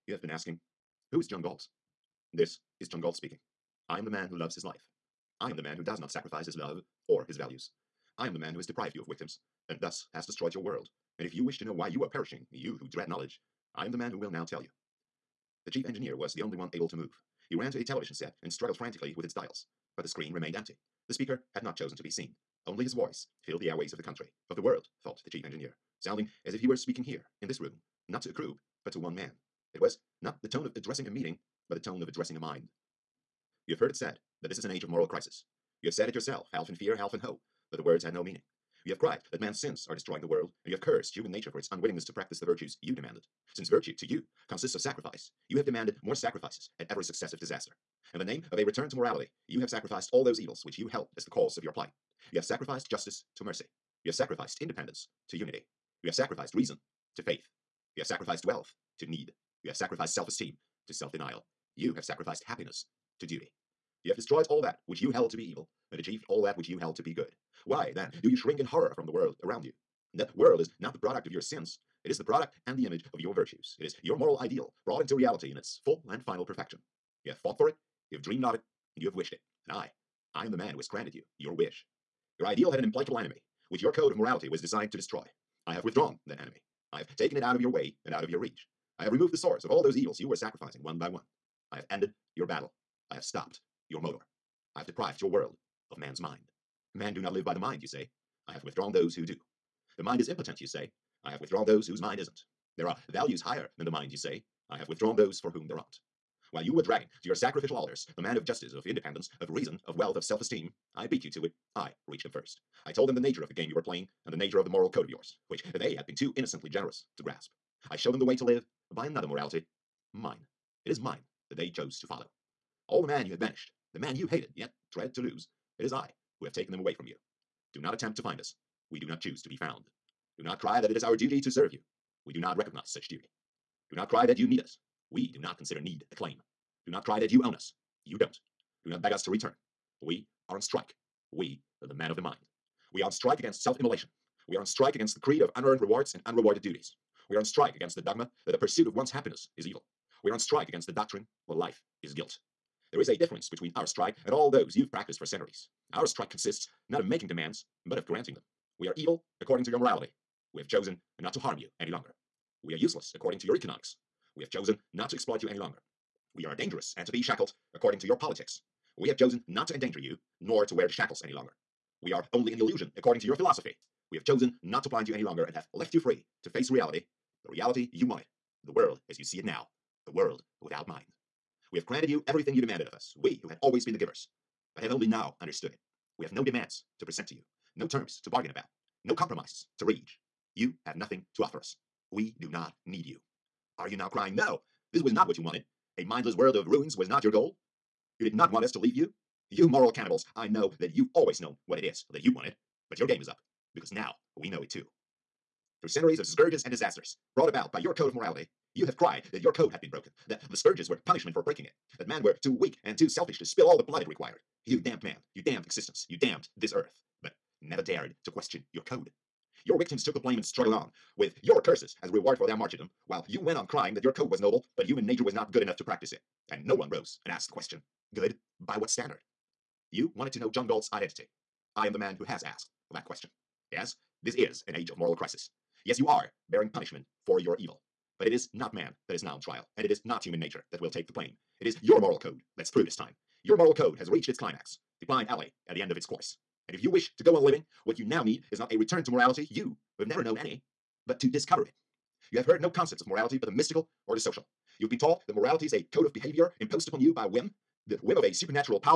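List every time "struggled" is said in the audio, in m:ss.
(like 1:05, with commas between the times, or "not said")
0:18, 3:40.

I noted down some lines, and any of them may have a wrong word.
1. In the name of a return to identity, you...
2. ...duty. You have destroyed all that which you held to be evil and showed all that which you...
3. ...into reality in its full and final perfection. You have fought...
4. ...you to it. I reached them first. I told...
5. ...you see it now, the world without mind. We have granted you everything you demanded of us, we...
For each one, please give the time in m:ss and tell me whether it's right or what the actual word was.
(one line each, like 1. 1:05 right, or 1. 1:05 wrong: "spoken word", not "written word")
1. 0:48 wrong: "morality", not "identity"
2. 1:03 wrong: "achieved", not "showed"
3. 1:14 right
4. 1:51 right
5. 2:59 right.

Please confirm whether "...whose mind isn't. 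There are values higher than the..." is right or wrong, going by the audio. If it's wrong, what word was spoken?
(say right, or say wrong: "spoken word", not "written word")
right.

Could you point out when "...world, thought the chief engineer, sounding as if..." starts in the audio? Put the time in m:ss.
0:24.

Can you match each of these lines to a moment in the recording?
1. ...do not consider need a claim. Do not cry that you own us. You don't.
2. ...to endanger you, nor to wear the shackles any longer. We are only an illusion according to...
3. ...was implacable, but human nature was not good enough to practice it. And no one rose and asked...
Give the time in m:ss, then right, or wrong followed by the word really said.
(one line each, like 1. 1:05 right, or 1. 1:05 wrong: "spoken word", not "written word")
1. 2:15 right
2. 2:49 right
3. 3:44 wrong: "noble", not "implacable".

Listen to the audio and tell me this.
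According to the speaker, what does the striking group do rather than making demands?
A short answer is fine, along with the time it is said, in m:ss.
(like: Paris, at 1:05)
Granting them, at 2:38.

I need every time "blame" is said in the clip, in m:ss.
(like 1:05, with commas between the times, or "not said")
3:40, 4:01.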